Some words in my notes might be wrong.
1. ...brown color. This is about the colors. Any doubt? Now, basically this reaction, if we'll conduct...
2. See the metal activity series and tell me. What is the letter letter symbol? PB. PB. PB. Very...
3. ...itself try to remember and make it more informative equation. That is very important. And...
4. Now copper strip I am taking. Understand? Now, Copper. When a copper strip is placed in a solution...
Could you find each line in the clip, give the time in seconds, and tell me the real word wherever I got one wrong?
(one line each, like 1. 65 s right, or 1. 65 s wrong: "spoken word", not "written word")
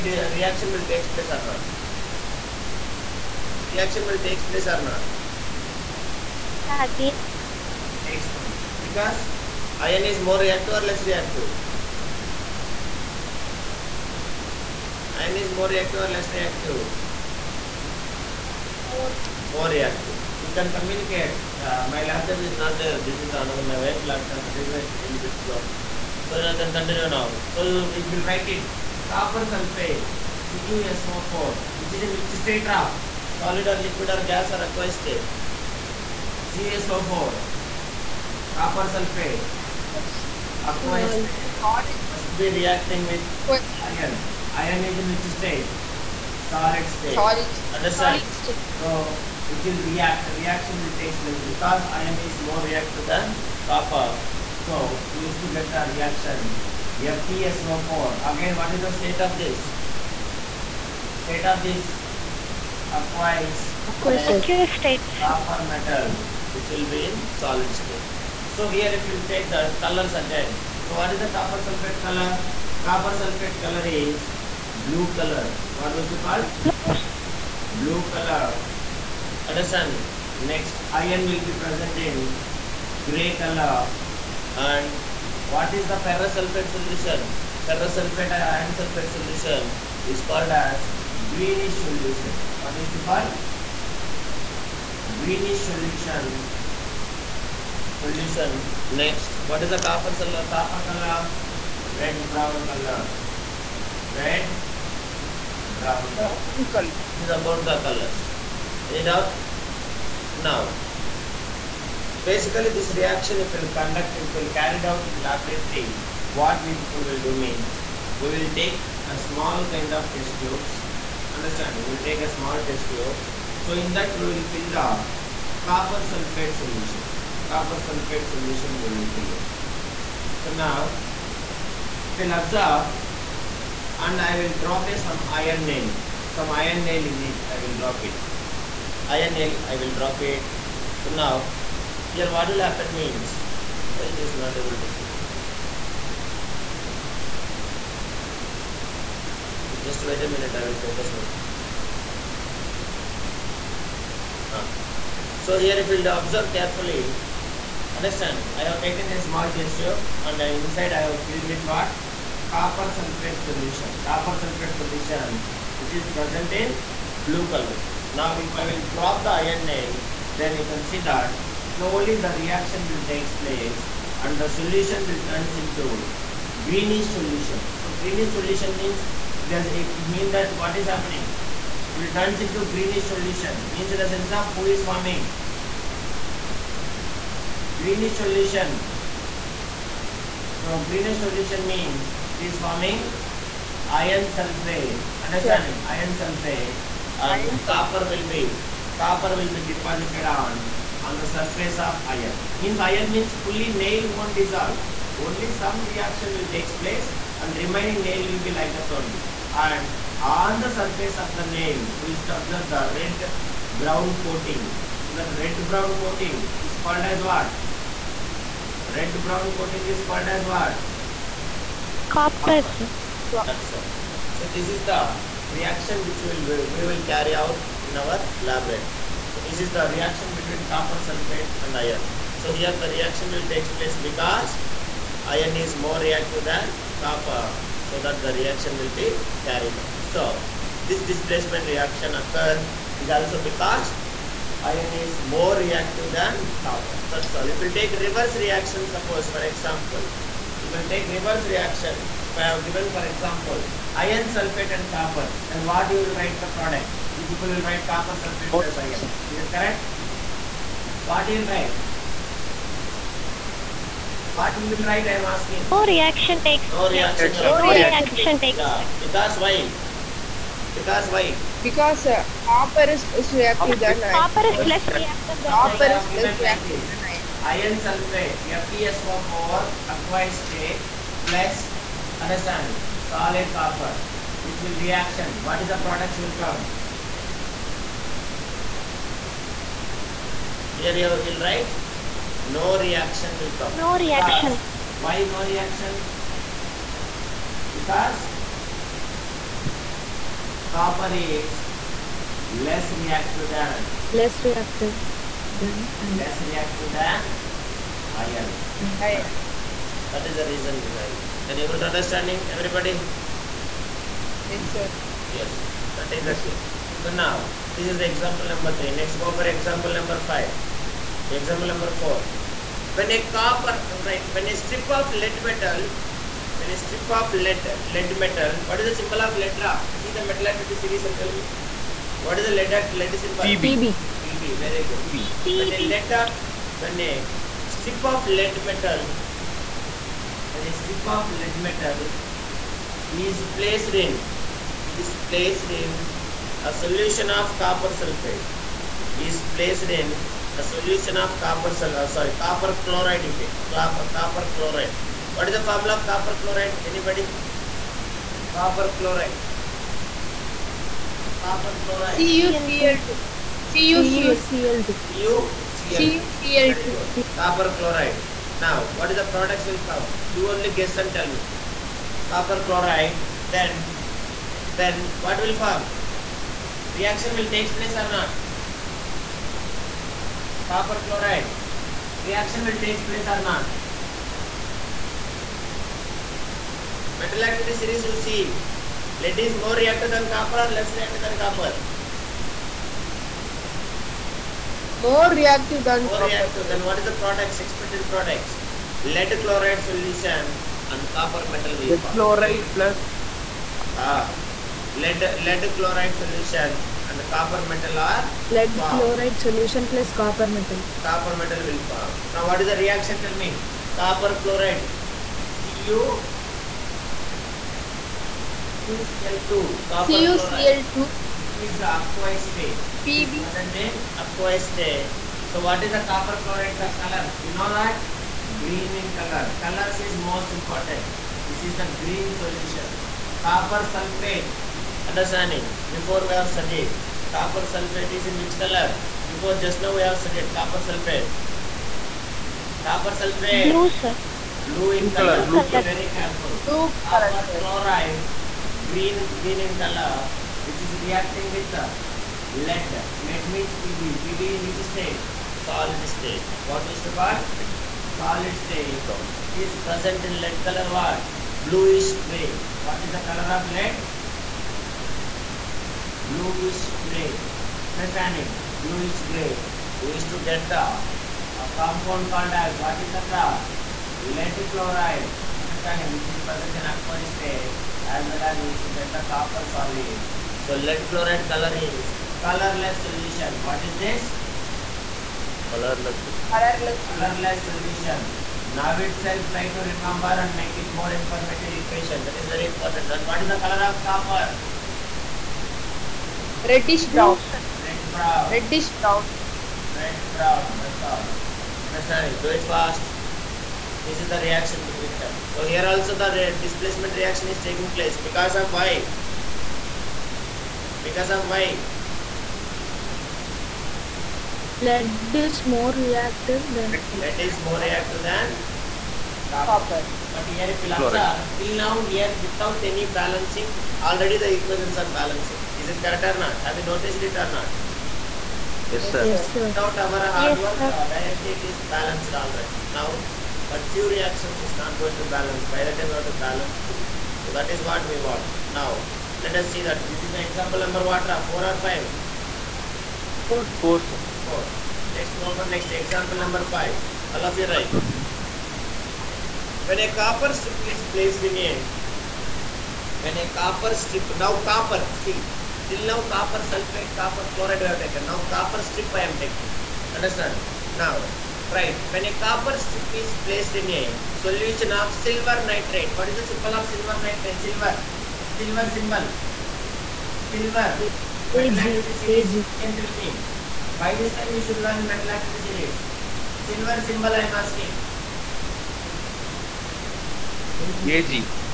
1. 105 s right
2. 329 s right
3. 488 s right
4. 558 s wrong: "Right", not "Copper".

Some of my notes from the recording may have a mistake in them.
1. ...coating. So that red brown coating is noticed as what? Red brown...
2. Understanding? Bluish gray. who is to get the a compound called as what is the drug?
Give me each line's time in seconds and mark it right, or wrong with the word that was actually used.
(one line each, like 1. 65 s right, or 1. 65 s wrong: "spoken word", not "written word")
1. 214 s wrong: "called", not "noticed"
2. 467 s right.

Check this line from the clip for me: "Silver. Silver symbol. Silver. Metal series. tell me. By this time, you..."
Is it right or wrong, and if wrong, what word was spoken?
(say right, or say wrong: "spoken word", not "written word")
right.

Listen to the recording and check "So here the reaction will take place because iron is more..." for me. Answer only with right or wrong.
right.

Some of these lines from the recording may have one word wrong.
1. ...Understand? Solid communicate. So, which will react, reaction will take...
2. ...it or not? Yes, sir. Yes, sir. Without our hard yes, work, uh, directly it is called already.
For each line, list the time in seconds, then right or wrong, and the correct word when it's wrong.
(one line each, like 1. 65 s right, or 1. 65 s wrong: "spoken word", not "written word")
1. 47 s wrong: "state", not "communicate"
2. 527 s wrong: "balanced", not "called".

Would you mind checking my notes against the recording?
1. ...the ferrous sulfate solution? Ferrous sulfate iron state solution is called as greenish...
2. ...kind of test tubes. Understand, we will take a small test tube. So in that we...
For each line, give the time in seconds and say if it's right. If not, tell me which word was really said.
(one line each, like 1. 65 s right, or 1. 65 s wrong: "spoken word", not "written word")
1. 85 s wrong: "sulfate", not "state"
2. 119 s right.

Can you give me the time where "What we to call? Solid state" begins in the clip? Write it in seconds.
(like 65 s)
456 s.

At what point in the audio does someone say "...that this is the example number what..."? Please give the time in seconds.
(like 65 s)
539 s.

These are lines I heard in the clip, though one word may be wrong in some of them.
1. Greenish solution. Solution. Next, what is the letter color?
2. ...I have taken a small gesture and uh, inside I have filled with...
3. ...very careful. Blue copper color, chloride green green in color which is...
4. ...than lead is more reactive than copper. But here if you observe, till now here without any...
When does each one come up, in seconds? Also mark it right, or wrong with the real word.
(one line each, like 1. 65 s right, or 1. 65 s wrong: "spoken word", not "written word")
1. 95 s wrong: "copper", not "letter"
2. 158 s right
3. 445 s right
4. 516 s right.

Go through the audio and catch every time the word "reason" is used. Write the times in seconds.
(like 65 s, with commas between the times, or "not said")
310 s.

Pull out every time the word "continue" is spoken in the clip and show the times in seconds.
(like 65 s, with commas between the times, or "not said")
26 s.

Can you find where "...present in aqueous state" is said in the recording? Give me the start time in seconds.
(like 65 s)
476 s.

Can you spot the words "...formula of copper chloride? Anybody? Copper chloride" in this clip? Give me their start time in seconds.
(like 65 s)
355 s.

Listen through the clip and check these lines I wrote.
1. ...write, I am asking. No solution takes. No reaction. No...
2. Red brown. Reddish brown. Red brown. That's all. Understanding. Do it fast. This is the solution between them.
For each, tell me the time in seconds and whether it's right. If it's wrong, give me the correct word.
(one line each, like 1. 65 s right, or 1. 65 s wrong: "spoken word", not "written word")
1. 264 s wrong: "reaction", not "solution"
2. 497 s wrong: "reaction", not "solution".